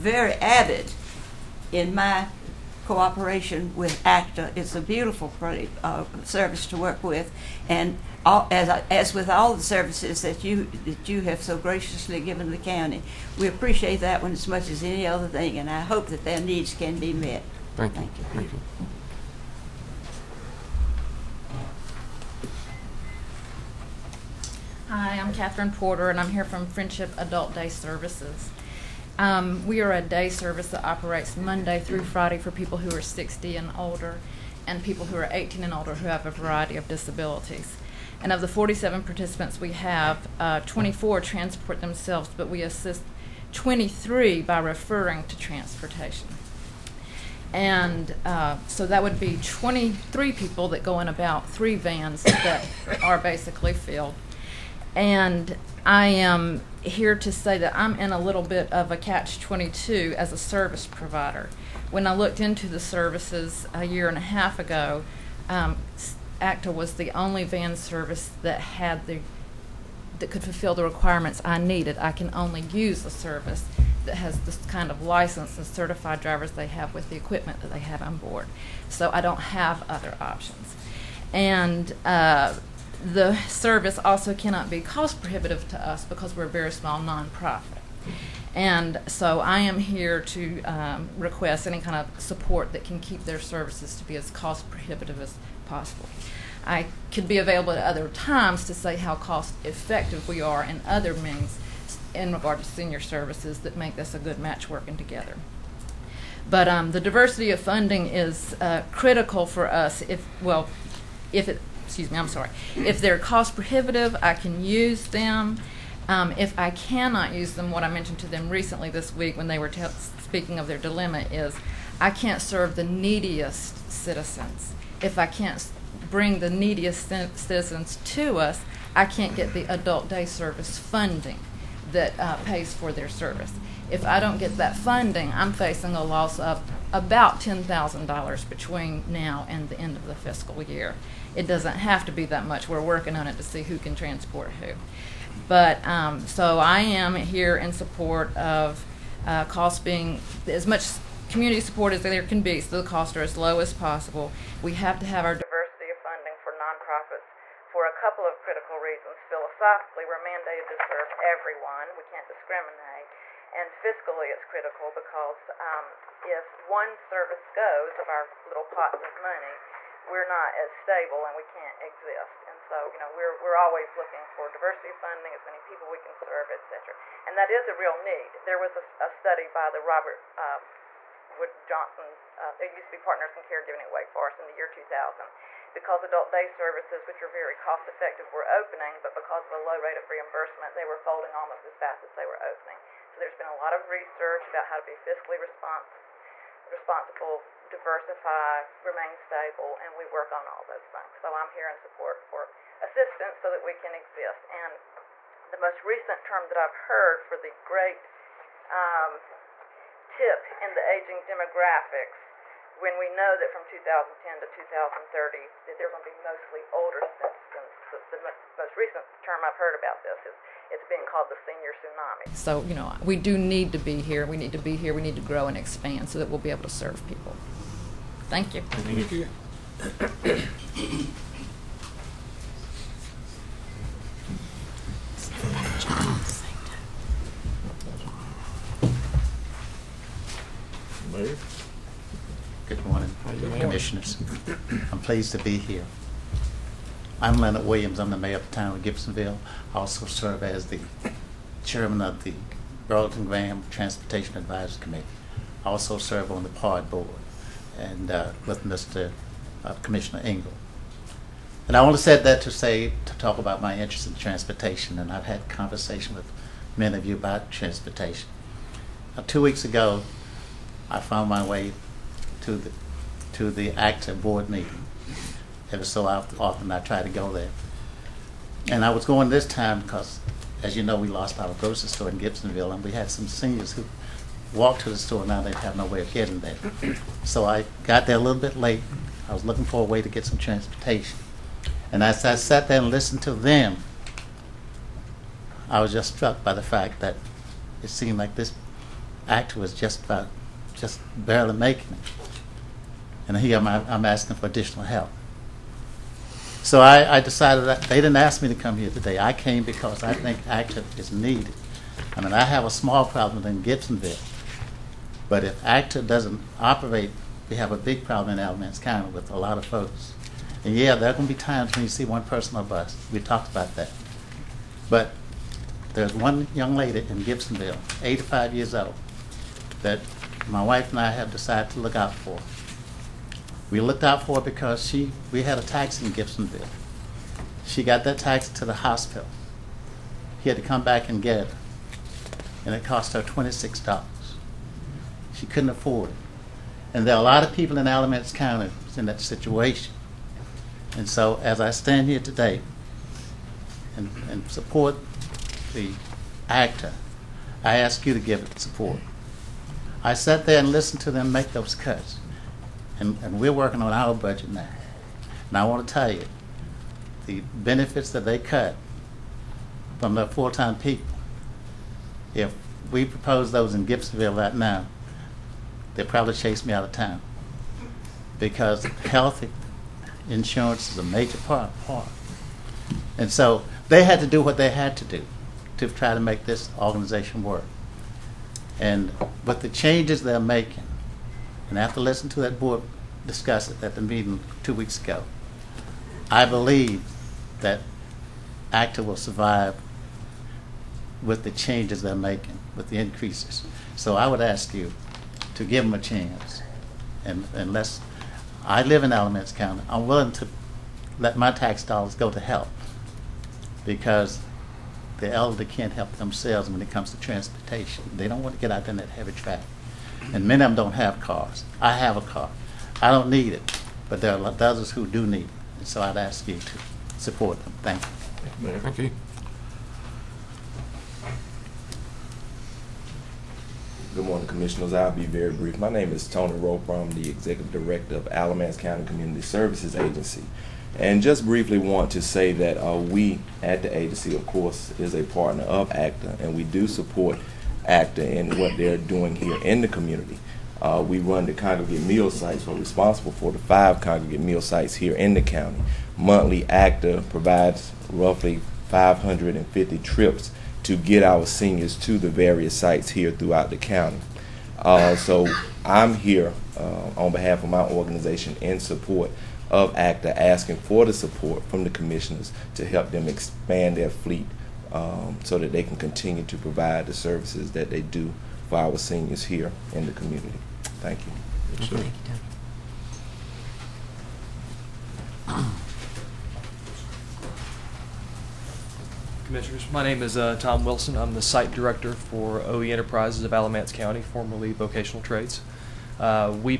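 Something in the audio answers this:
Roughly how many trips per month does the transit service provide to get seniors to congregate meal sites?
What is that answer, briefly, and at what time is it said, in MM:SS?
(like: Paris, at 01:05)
550, at 07:38.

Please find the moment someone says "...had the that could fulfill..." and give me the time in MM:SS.
01:08.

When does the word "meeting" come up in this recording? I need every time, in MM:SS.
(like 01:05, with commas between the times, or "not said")
04:34, 06:34.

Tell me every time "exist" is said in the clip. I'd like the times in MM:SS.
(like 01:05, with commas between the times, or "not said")
02:51, 03:23.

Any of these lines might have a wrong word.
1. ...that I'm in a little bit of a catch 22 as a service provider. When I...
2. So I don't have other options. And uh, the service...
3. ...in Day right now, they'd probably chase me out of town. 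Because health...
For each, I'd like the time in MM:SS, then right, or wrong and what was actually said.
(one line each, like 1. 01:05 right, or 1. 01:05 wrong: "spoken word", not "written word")
1. 00:57 right
2. 01:18 right
3. 06:13 wrong: "Gibsonville", not "Day".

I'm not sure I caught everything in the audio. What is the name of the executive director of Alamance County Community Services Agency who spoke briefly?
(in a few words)
Tony Roper.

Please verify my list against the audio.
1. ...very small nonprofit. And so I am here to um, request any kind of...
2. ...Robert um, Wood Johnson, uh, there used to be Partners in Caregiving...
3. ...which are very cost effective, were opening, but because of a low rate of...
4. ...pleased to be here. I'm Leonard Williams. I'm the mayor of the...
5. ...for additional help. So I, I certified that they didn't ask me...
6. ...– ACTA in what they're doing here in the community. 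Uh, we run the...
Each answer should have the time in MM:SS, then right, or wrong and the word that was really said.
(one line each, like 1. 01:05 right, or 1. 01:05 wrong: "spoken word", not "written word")
1. 01:26 right
2. 02:59 right
3. 03:07 right
4. 04:04 right
5. 05:04 wrong: "decided", not "certified"
6. 07:27 right.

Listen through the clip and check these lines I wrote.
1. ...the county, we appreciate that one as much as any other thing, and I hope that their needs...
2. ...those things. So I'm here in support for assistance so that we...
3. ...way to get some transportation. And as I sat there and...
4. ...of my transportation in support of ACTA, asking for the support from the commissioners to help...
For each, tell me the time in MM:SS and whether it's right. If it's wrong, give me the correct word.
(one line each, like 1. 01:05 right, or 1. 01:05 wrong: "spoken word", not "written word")
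1. 00:12 right
2. 03:20 right
3. 04:49 right
4. 07:47 wrong: "organization", not "transportation".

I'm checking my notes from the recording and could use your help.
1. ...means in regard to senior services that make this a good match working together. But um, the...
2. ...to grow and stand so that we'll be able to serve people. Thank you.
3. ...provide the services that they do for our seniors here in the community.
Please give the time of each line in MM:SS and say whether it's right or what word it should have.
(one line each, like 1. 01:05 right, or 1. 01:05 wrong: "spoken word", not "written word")
1. 01:41 right
2. 03:45 wrong: "expand", not "stand"
3. 07:56 right.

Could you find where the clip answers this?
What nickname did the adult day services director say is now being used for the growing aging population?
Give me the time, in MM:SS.
03:41.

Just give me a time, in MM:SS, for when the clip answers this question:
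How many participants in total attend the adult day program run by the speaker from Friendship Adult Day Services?
00:38.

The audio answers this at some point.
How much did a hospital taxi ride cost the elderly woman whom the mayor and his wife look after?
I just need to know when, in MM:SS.
05:43.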